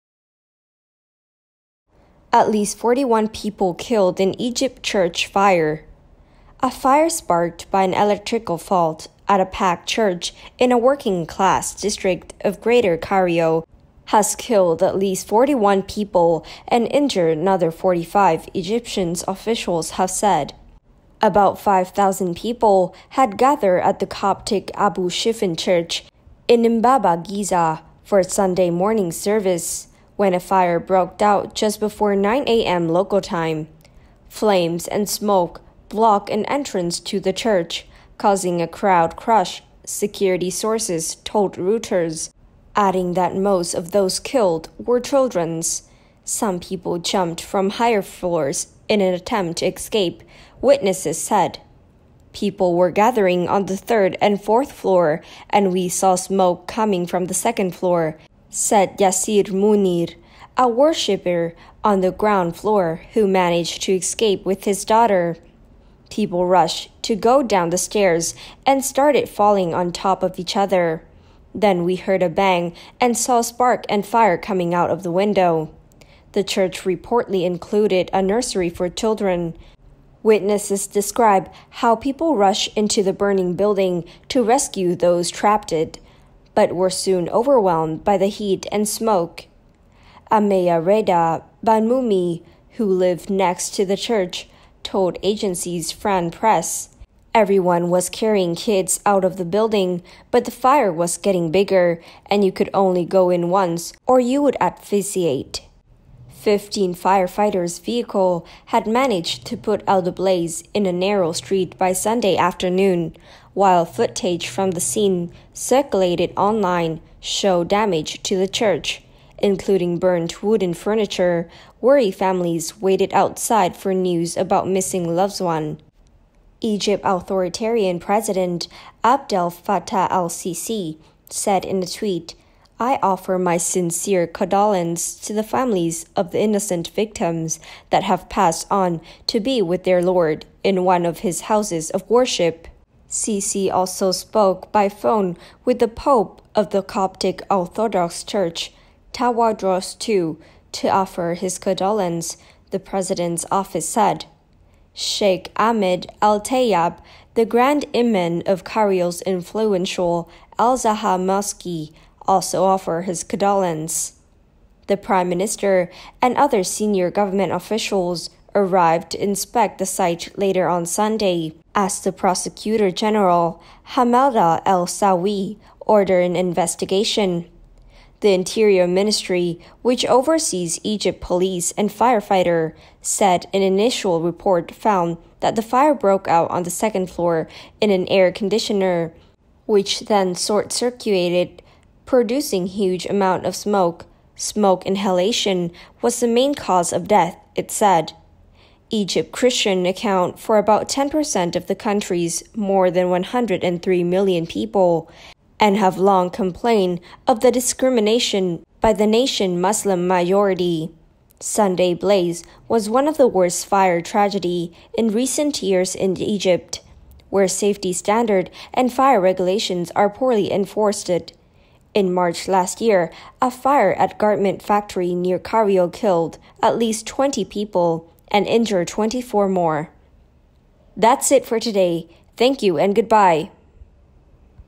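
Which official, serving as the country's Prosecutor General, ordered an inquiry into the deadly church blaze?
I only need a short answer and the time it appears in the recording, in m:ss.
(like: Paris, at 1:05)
Hamada El Sawi, at 2:53.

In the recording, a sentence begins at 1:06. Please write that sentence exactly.
People rushed to go down the stairs and started falling on top of each other.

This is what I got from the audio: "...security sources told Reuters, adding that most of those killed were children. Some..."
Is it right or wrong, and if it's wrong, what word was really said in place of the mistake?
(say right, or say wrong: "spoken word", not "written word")
right.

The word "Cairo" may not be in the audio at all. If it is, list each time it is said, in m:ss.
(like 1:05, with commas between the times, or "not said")
0:12, 2:38, 3:45.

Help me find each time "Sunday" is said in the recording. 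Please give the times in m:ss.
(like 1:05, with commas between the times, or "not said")
0:28, 1:51, 2:50, 3:31.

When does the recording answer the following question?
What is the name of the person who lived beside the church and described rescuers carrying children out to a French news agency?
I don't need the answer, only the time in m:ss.
1:30.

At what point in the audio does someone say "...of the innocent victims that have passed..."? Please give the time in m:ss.
2:16.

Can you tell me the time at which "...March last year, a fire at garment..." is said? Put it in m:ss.
3:42.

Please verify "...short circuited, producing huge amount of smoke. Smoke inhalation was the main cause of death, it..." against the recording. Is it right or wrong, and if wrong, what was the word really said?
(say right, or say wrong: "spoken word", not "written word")
right.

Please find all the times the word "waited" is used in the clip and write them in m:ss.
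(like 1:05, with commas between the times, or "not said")
2:02.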